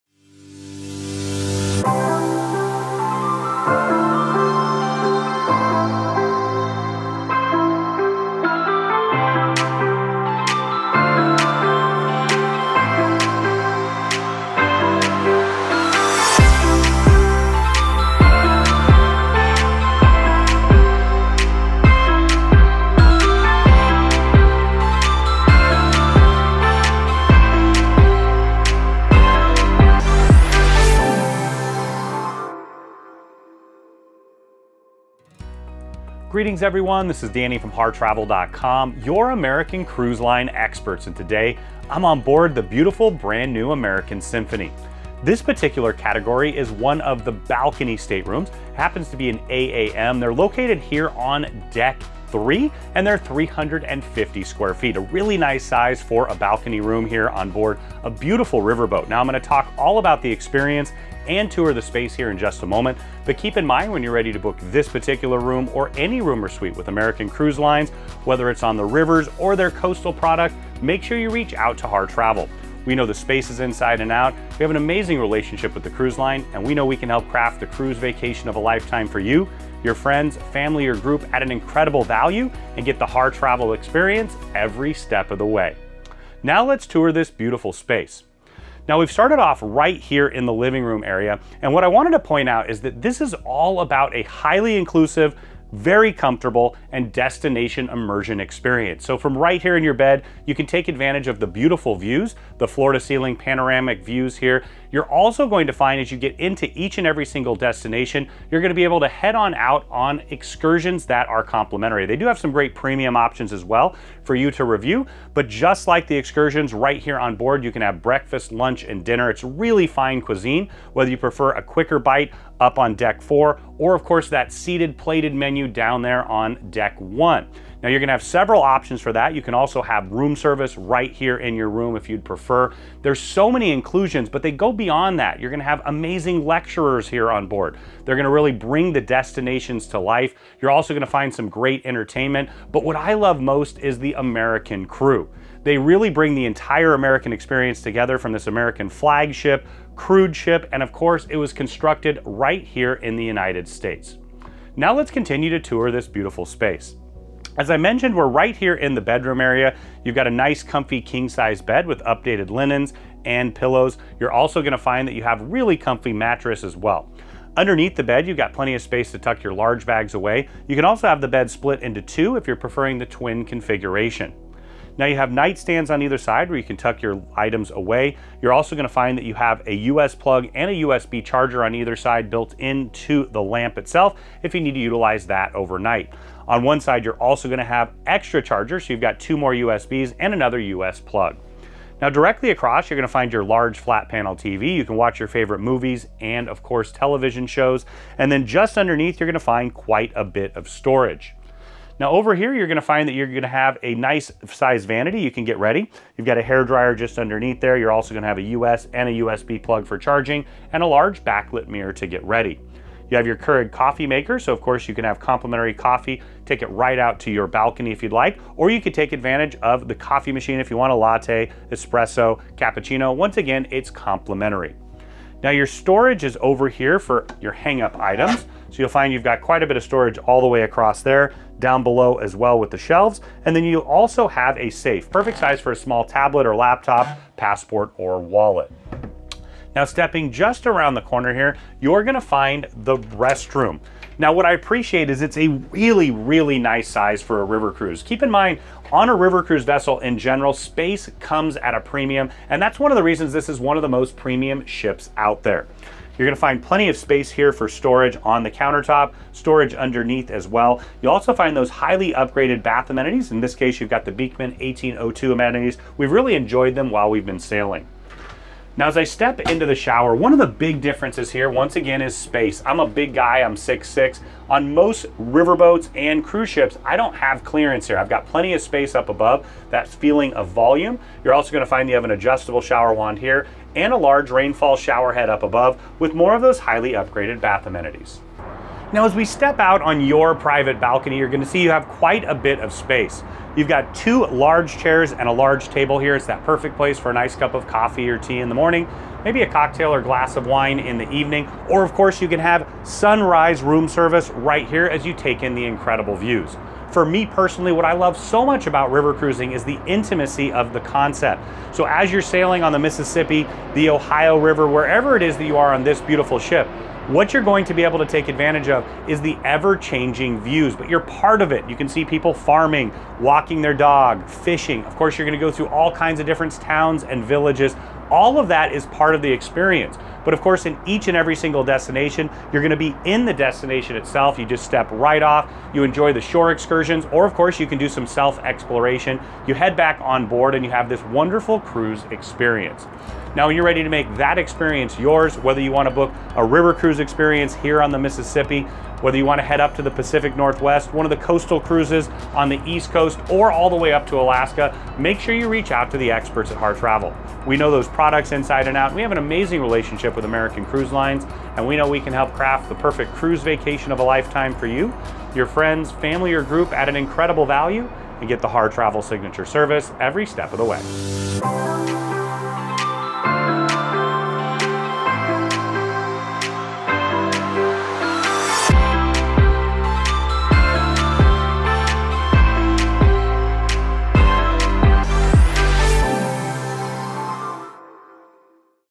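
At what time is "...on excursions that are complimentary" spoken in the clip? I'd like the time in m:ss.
1:49.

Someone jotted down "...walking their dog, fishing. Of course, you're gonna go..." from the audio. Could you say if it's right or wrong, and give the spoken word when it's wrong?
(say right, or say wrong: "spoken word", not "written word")
right.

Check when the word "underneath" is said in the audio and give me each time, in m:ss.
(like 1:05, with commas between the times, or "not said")
2:47, 3:18, 3:27, 4:19.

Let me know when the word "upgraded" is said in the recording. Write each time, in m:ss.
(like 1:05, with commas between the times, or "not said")
4:22, 4:46.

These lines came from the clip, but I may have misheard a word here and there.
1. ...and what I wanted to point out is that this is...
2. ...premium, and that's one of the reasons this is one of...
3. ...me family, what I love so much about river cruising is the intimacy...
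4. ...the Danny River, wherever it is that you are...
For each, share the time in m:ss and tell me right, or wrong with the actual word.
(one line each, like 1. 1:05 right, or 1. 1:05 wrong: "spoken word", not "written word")
1. 1:31 right
2. 4:11 right
3. 5:07 wrong: "personally", not "family"
4. 5:13 wrong: "Ohio", not "Danny".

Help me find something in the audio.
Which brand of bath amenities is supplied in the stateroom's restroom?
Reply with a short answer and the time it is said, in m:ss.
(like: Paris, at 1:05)
Beekman 1802, at 4:24.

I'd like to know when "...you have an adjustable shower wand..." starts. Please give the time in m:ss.
4:41.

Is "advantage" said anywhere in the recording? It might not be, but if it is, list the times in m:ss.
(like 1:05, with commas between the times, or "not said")
1:40, 3:39, 5:18.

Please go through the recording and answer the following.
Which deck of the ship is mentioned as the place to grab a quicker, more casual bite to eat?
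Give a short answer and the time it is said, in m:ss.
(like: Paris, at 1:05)
Deck 4, at 2:02.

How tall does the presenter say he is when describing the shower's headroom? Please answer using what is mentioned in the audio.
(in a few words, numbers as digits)
6'6".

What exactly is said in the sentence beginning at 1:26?
Now let's tour this beautiful space.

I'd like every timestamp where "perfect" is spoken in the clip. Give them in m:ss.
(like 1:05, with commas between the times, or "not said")
3:55, 4:56, 6:02.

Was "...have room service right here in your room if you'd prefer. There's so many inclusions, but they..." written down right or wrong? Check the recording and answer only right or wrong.
right.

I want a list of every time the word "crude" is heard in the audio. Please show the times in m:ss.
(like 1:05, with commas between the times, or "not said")
2:29.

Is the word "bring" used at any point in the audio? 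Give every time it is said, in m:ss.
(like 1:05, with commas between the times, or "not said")
2:18, 2:26.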